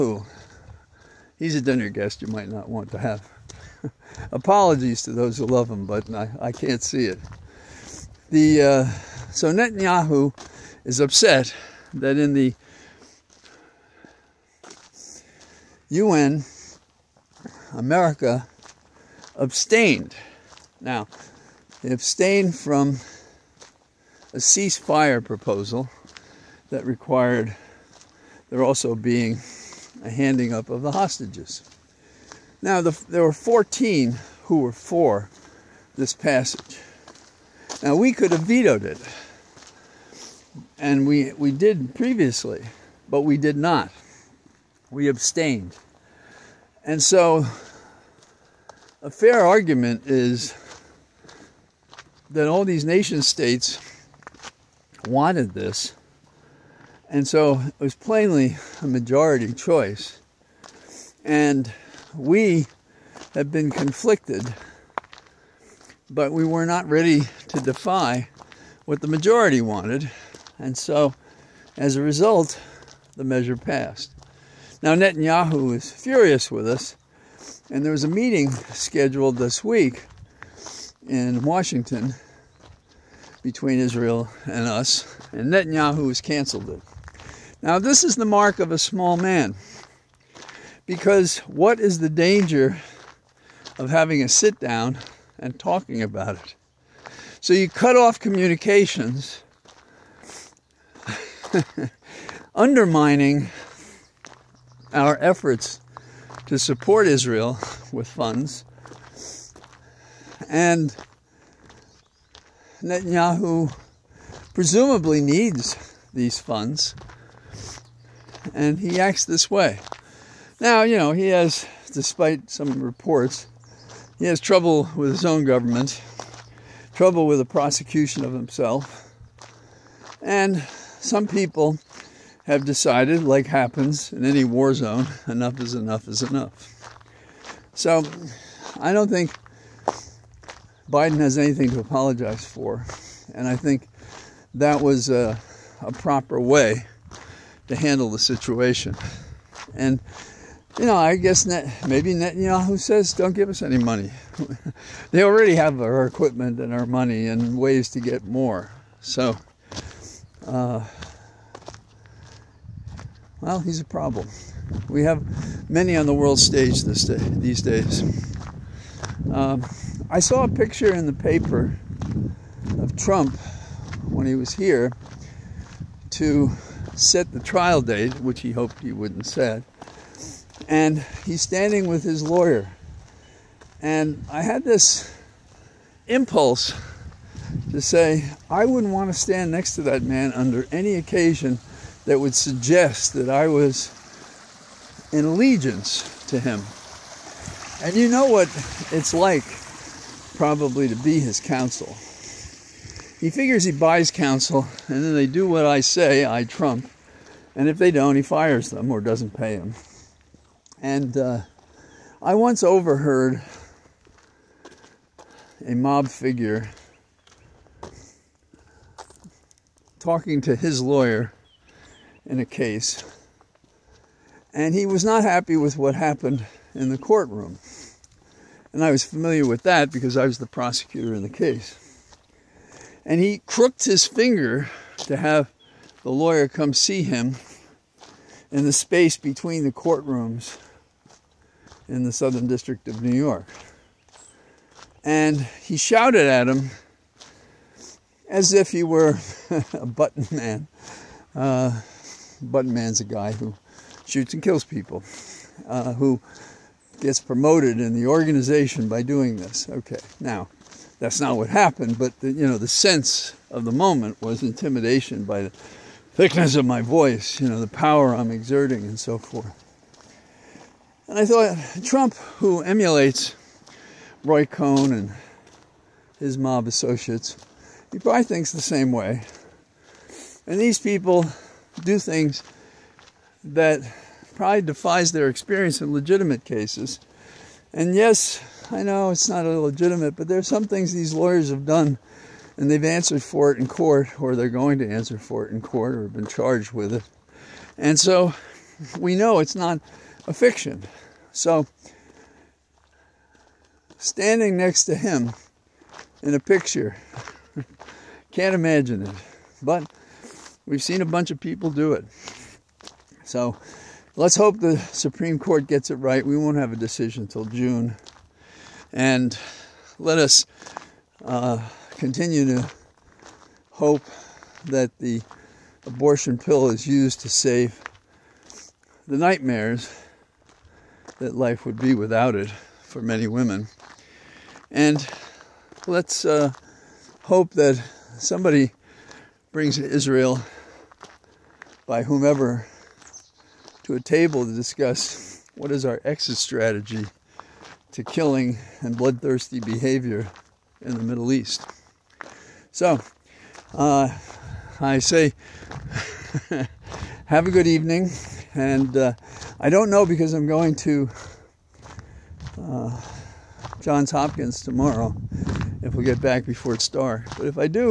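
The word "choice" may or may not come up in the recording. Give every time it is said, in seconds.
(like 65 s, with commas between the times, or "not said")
59 s.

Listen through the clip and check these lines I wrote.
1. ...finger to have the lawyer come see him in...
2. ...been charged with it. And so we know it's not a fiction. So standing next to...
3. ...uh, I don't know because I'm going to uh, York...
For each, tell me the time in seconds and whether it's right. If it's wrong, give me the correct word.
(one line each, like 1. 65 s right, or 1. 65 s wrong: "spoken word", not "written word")
1. 234 s right
2. 296 s right
3. 358 s wrong: "Johns", not "York".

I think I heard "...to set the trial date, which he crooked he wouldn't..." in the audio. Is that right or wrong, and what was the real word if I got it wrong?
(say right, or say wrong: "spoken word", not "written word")
wrong: "hoped", not "crooked".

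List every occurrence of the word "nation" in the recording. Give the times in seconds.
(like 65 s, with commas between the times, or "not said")
52 s.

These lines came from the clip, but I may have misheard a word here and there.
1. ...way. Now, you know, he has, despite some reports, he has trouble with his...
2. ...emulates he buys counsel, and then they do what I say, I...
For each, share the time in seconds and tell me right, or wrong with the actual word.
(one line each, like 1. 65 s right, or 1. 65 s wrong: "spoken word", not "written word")
1. 119 s right
2. 203 s wrong: "figures", not "emulates".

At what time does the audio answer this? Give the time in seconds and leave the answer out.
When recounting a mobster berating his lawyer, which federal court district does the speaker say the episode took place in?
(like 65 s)
242 s.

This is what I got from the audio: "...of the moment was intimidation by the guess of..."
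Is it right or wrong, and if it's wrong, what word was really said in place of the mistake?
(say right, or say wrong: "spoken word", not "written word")
wrong: "thickness", not "guess".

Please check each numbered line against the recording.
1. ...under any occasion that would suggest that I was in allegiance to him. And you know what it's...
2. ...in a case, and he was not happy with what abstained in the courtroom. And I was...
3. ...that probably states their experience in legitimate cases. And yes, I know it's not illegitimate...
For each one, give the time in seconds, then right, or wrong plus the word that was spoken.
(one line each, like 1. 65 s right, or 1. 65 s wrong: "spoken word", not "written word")
1. 190 s right
2. 222 s wrong: "happened", not "abstained"
3. 283 s wrong: "defies", not "states".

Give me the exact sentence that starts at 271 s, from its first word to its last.
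And I thought Trump, who emulates Roy Cohn and his mob associates, he probably thinks the same way.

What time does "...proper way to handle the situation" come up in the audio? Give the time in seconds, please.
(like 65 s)
145 s.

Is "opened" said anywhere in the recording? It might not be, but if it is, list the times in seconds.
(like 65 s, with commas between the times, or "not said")
not said.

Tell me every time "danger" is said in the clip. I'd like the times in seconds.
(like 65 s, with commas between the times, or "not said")
92 s.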